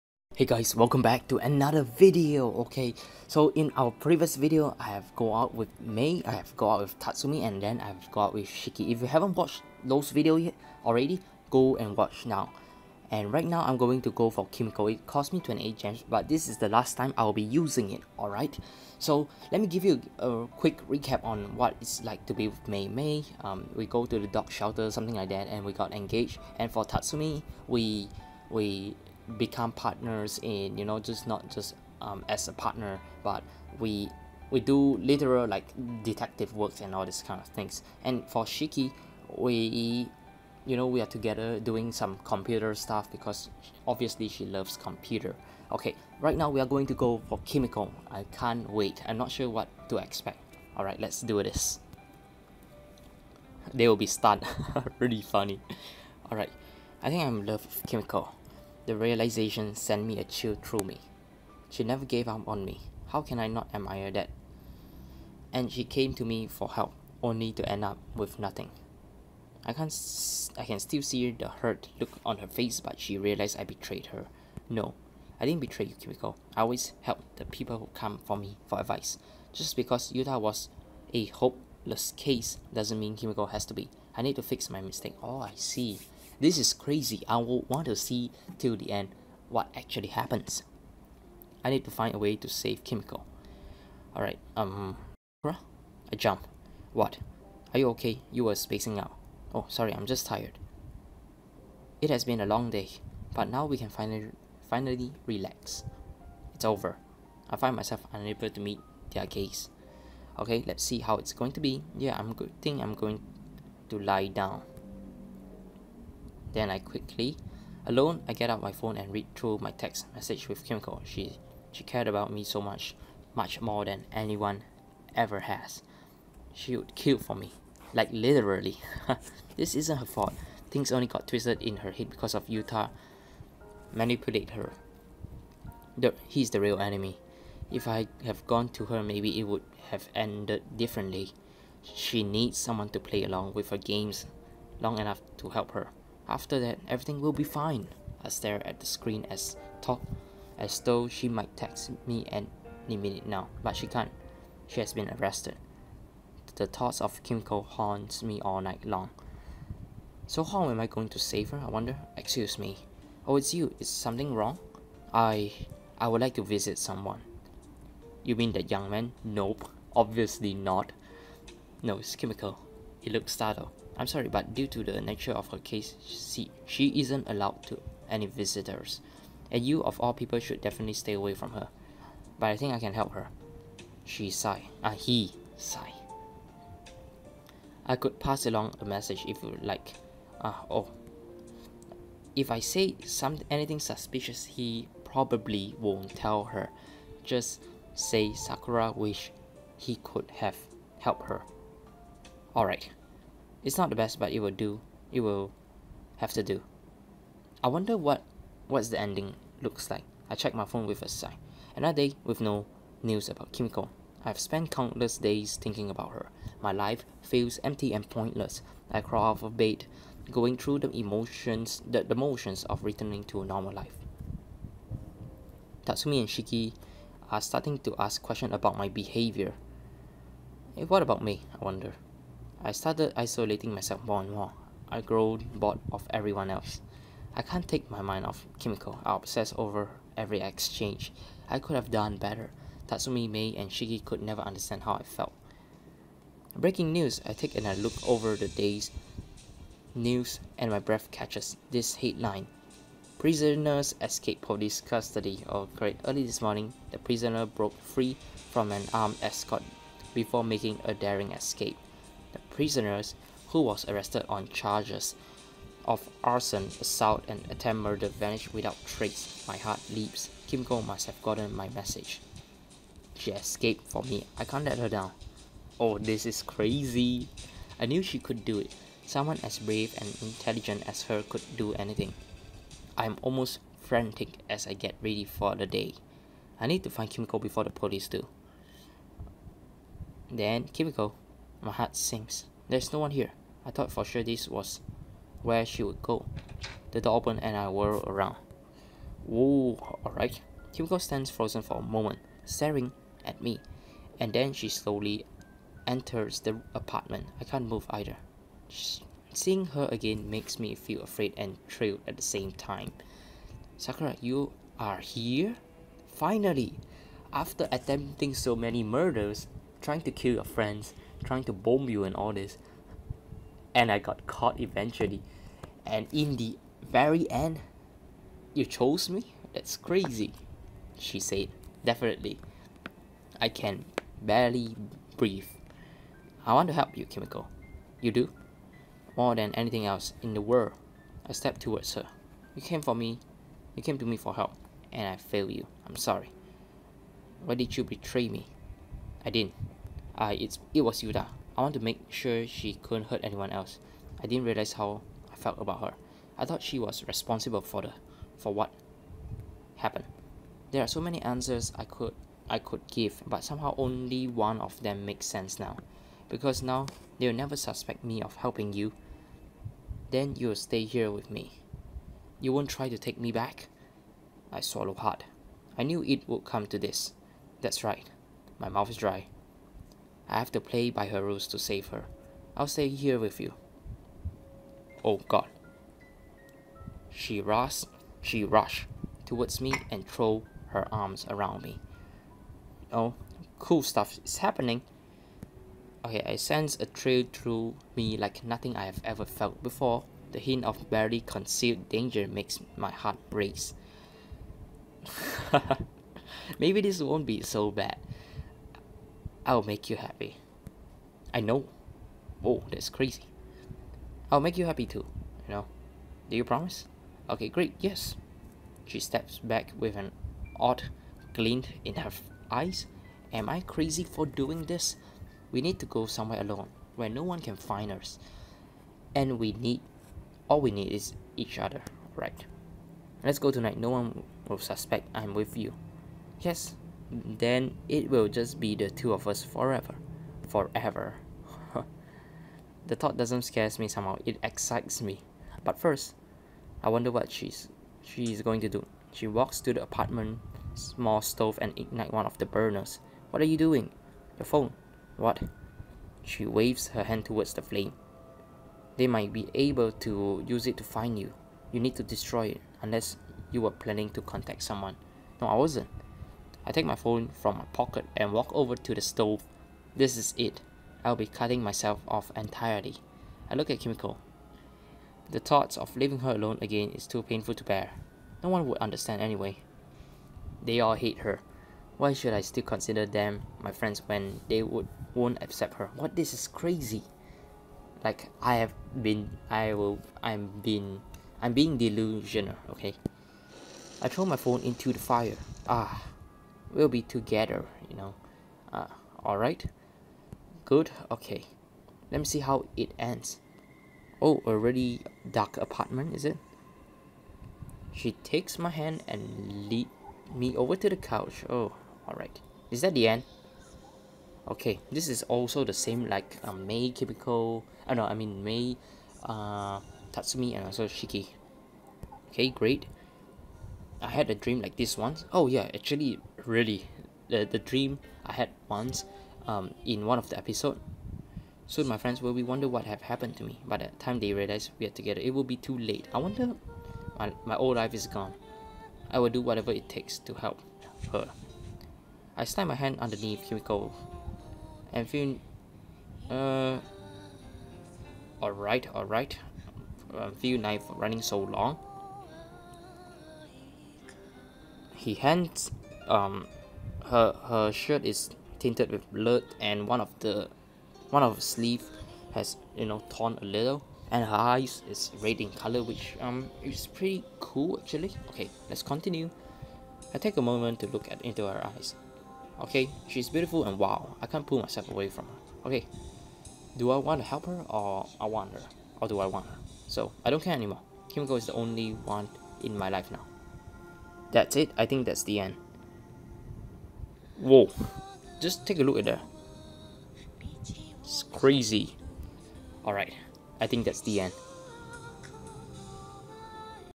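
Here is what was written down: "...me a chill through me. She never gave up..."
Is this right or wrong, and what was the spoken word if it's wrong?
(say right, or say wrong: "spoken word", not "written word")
right.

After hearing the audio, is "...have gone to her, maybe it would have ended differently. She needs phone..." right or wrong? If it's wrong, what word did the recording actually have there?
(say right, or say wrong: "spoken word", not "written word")
wrong: "someone", not "phone".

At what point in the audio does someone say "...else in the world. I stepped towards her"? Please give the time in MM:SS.
05:39.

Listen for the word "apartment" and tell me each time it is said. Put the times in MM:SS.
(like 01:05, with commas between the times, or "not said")
05:06, 07:29, 08:25.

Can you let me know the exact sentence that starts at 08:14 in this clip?
I throw my phone into the fire.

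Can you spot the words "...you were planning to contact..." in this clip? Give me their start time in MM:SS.
07:43.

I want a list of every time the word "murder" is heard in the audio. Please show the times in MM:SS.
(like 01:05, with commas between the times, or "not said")
04:27, 05:18.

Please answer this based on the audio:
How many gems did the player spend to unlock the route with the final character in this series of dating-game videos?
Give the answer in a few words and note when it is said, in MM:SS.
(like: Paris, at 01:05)
28, at 00:15.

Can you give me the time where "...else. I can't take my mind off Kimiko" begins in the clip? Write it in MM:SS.
03:56.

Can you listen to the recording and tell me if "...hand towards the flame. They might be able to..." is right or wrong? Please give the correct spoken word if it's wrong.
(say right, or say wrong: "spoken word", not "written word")
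right.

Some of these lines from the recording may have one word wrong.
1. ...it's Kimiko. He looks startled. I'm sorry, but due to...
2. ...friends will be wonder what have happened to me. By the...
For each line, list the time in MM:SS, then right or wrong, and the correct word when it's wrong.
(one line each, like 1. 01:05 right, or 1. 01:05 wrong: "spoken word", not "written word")
1. 02:51 right
2. 08:51 right.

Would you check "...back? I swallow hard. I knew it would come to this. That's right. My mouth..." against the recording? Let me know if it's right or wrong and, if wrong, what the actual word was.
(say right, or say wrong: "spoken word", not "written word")
right.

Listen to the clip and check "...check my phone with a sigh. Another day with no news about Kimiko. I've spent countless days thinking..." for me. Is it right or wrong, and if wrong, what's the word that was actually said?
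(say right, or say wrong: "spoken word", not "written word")
right.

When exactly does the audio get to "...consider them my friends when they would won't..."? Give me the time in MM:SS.
08:02.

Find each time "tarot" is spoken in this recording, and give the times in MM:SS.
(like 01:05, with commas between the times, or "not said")
not said.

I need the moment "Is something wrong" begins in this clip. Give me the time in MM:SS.
02:43.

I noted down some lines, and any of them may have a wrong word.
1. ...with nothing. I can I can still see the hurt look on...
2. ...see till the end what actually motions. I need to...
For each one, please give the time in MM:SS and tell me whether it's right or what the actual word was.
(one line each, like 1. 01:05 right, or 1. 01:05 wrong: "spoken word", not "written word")
1. 01:08 right
2. 01:27 wrong: "happens", not "motions".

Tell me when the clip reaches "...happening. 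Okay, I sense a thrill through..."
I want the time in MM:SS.
06:34.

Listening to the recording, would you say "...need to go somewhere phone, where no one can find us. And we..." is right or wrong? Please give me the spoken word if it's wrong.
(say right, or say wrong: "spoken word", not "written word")
wrong: "alone", not "phone".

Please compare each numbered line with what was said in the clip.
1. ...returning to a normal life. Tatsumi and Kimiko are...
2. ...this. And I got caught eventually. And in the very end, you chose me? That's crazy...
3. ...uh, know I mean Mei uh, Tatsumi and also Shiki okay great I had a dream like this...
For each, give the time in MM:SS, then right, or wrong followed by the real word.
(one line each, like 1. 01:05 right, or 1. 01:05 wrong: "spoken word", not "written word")
1. 03:42 wrong: "Shiki", not "Kimiko"
2. 05:22 right
3. 08:37 right.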